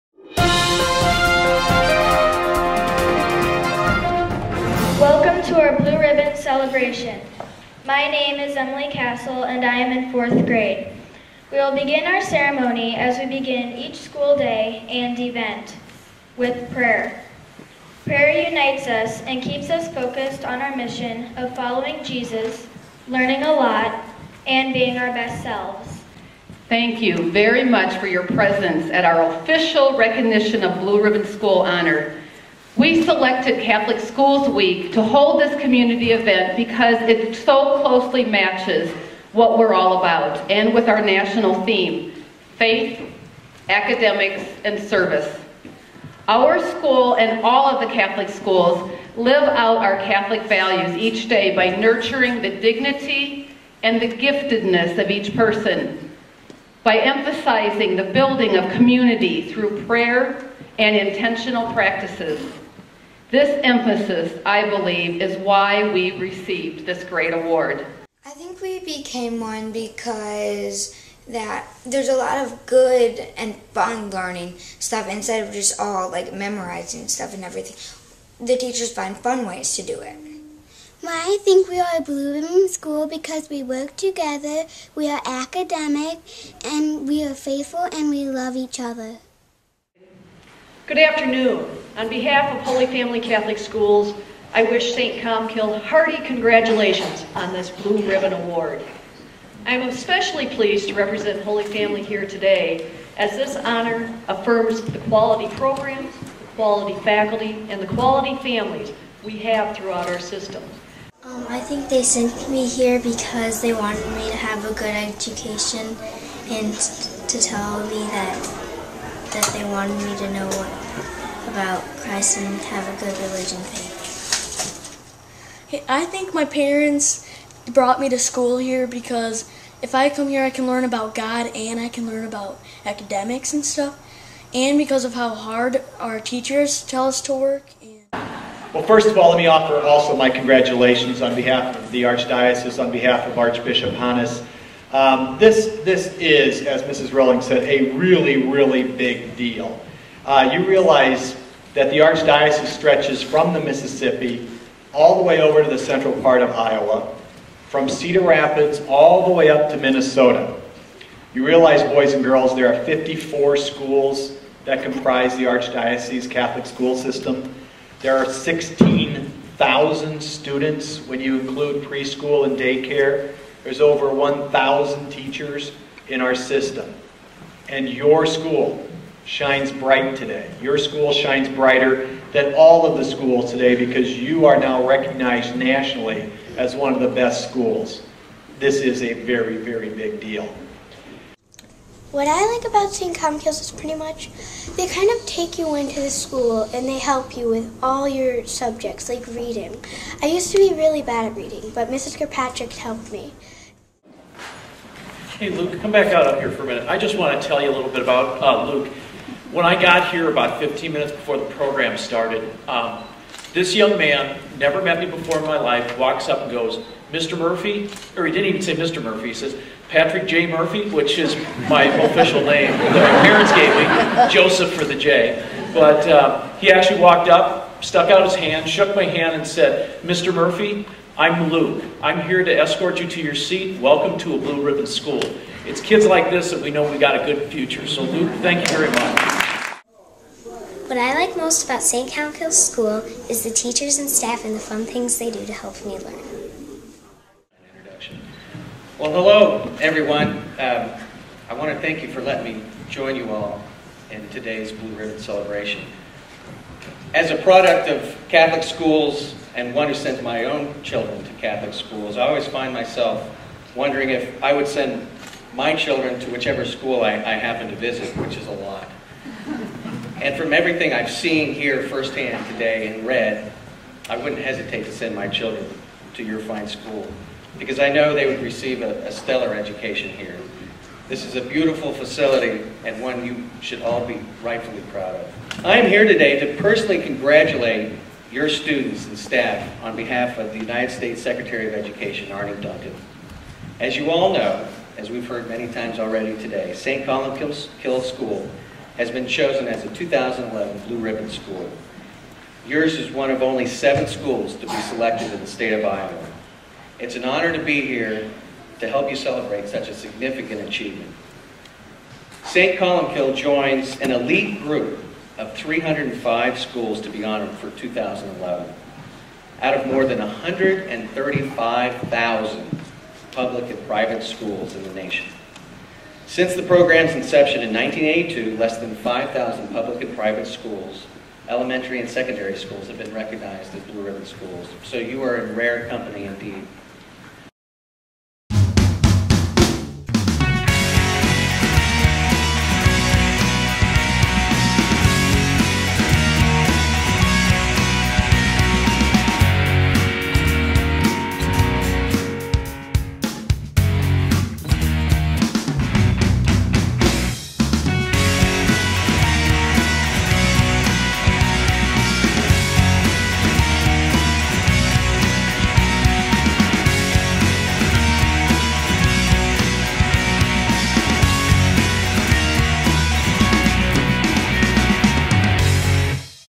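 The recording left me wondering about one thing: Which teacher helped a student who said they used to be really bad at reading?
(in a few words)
Mrs. Kirkpatrick.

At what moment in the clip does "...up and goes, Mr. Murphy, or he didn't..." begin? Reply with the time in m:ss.
3:36.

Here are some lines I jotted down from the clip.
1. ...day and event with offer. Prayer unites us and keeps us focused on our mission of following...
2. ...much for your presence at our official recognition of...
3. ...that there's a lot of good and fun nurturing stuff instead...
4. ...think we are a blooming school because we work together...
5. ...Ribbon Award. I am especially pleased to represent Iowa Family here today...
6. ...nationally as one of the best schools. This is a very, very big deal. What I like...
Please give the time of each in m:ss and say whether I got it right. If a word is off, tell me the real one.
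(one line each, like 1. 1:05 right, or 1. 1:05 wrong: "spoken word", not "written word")
1. 0:14 wrong: "prayer", not "offer"
2. 0:27 right
3. 1:11 wrong: "learning", not "nurturing"
4. 1:21 right
5. 1:38 wrong: "Holy", not "Iowa"
6. 3:05 right.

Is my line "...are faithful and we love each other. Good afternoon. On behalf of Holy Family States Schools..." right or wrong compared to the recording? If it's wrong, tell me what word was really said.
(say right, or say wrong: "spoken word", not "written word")
wrong: "Catholic", not "States".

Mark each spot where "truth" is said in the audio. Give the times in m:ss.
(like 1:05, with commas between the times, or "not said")
not said.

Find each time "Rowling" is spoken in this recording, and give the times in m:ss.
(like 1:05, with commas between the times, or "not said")
2:27.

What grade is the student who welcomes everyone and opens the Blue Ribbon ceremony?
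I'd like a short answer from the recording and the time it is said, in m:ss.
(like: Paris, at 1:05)
Fourth grade, at 0:10.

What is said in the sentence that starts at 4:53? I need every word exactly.
As you all know, as we've heard many times already today, St.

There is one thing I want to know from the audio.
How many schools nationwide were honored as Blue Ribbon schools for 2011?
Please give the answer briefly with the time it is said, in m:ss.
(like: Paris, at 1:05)
305, at 5:15.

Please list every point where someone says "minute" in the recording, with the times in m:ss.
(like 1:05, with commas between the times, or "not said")
3:26, 3:30.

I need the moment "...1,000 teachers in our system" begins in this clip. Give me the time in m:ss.
2:54.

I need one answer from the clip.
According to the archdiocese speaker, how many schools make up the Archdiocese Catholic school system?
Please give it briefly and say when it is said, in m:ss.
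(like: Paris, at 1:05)
54, at 2:42.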